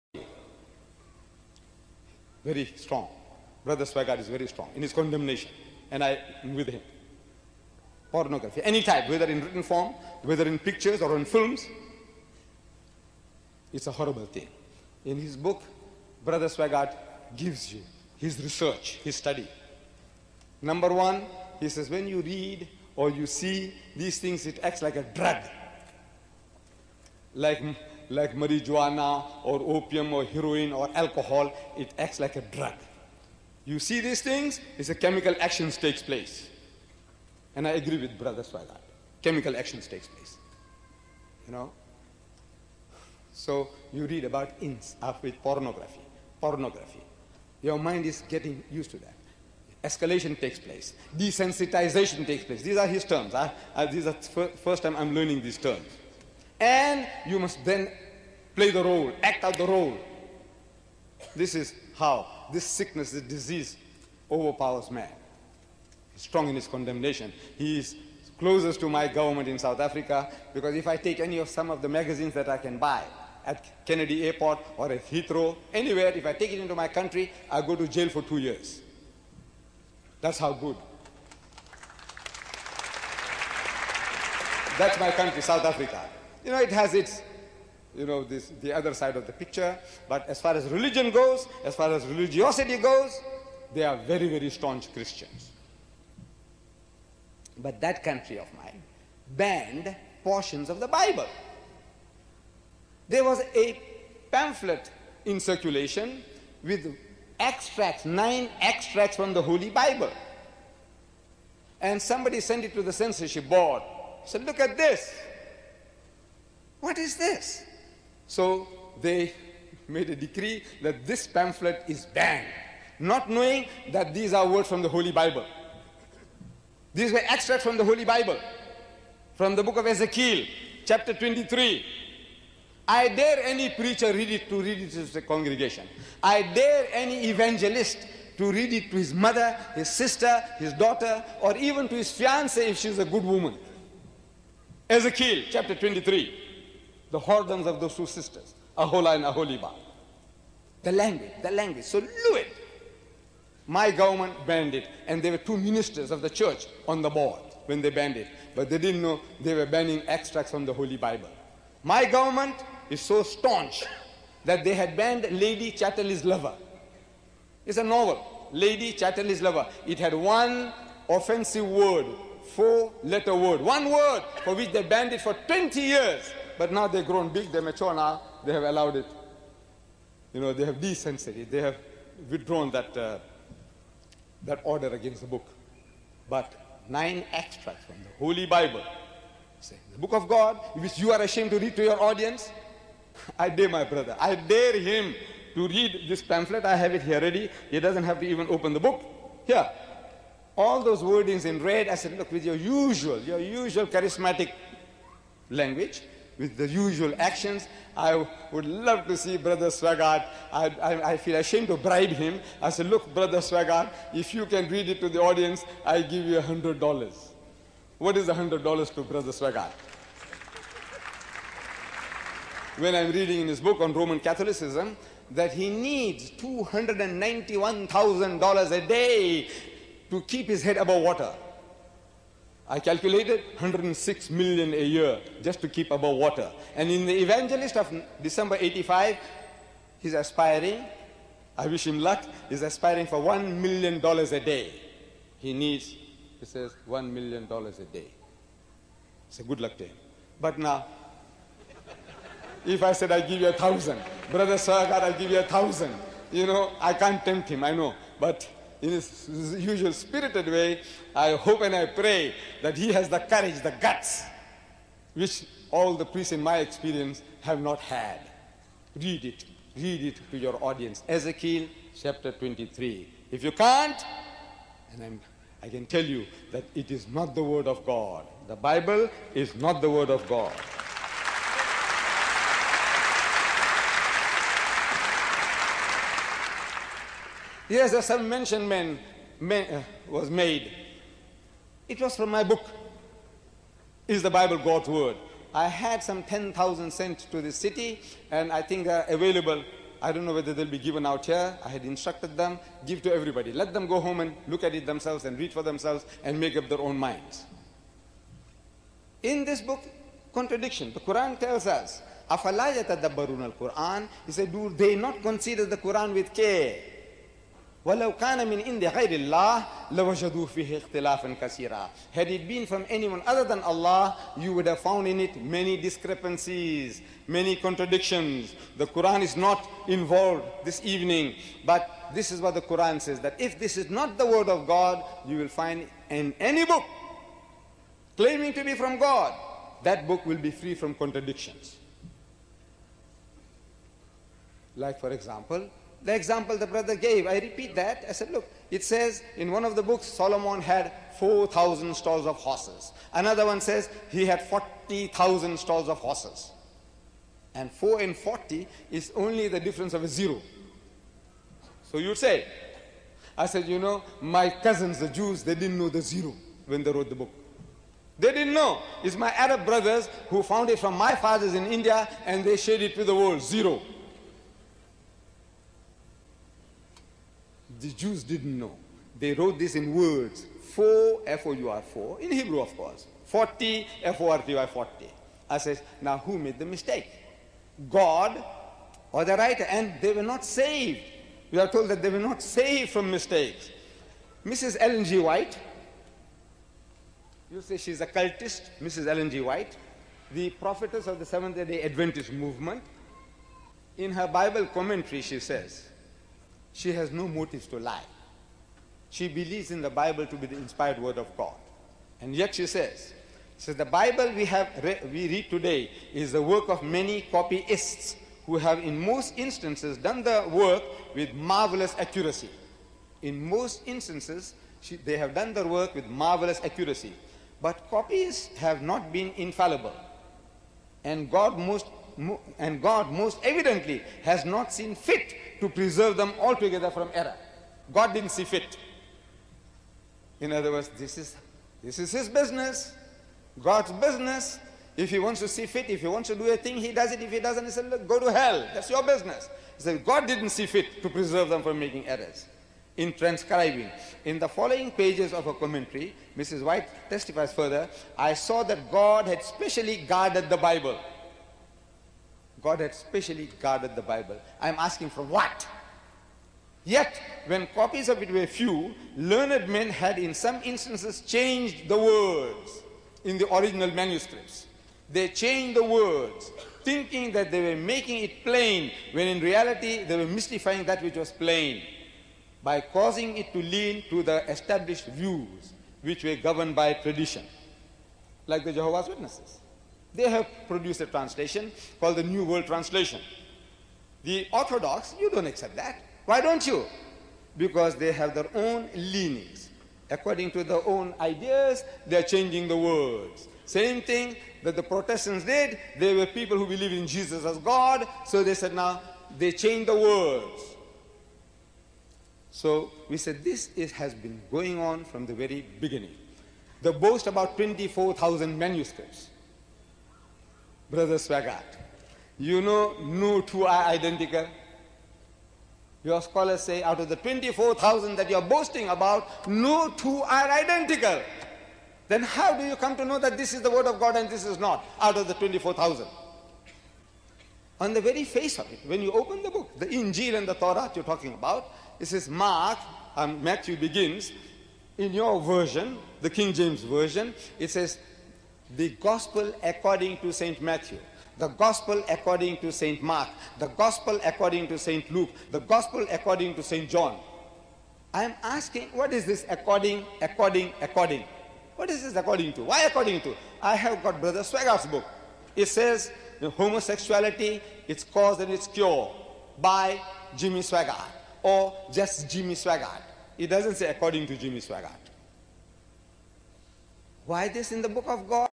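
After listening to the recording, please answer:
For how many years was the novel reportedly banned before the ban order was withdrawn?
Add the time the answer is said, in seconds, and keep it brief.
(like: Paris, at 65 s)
20, at 175 s.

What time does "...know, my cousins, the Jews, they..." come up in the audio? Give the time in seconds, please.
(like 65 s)
363 s.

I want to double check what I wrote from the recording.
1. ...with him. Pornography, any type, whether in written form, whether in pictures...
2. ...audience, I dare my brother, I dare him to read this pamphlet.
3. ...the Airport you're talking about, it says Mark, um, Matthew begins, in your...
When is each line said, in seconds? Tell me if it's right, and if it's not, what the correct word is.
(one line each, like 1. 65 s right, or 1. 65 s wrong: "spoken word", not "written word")
1. 6 s right
2. 192 s right
3. 540 s wrong: "Torah", not "Airport".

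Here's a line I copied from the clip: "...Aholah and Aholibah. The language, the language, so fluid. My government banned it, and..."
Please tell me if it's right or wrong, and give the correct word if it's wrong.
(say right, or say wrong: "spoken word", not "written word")
right.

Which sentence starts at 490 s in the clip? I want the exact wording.
They have produced a translation called the New World Translation.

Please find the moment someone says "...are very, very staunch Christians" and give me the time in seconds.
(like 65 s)
93 s.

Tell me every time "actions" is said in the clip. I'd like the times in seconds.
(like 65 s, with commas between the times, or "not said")
35 s, 39 s, 207 s.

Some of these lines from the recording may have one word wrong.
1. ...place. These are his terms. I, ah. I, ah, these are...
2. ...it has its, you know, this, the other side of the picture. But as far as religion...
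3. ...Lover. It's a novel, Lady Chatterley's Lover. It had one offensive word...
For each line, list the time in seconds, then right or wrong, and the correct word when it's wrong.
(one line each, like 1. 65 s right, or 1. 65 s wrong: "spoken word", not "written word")
1. 52 s right
2. 86 s right
3. 166 s right.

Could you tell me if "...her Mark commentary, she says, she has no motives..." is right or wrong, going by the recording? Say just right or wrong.
wrong.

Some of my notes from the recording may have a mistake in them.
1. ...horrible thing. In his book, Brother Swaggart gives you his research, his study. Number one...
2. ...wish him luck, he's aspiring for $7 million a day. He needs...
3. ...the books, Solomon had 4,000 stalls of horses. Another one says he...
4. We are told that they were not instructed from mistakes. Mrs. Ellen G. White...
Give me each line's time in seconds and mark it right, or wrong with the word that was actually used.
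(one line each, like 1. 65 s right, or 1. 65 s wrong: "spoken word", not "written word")
1. 13 s right
2. 241 s wrong: "1", not "7"
3. 349 s right
4. 391 s wrong: "saved", not "instructed".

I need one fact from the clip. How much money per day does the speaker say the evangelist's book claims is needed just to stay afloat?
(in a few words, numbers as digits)
$291,000.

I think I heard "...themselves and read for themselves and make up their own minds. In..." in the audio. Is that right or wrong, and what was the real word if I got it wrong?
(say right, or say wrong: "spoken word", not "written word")
right.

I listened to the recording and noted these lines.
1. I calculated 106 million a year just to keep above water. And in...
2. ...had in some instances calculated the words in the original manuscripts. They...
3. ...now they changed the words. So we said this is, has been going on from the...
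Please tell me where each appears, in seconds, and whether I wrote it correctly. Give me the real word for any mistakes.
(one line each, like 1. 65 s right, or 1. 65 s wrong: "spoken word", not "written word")
1. 232 s right
2. 469 s wrong: "changed", not "calculated"
3. 508 s right.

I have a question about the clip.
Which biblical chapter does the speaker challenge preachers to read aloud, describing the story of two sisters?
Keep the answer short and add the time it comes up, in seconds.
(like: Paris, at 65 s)
Ezekiel chapter 23, at 144 s.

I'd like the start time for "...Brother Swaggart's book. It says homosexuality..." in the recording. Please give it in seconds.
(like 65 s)
564 s.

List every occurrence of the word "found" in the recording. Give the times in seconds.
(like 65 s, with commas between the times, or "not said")
324 s, 370 s.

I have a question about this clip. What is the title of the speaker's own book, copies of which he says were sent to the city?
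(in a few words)
Is the Bible God's Word?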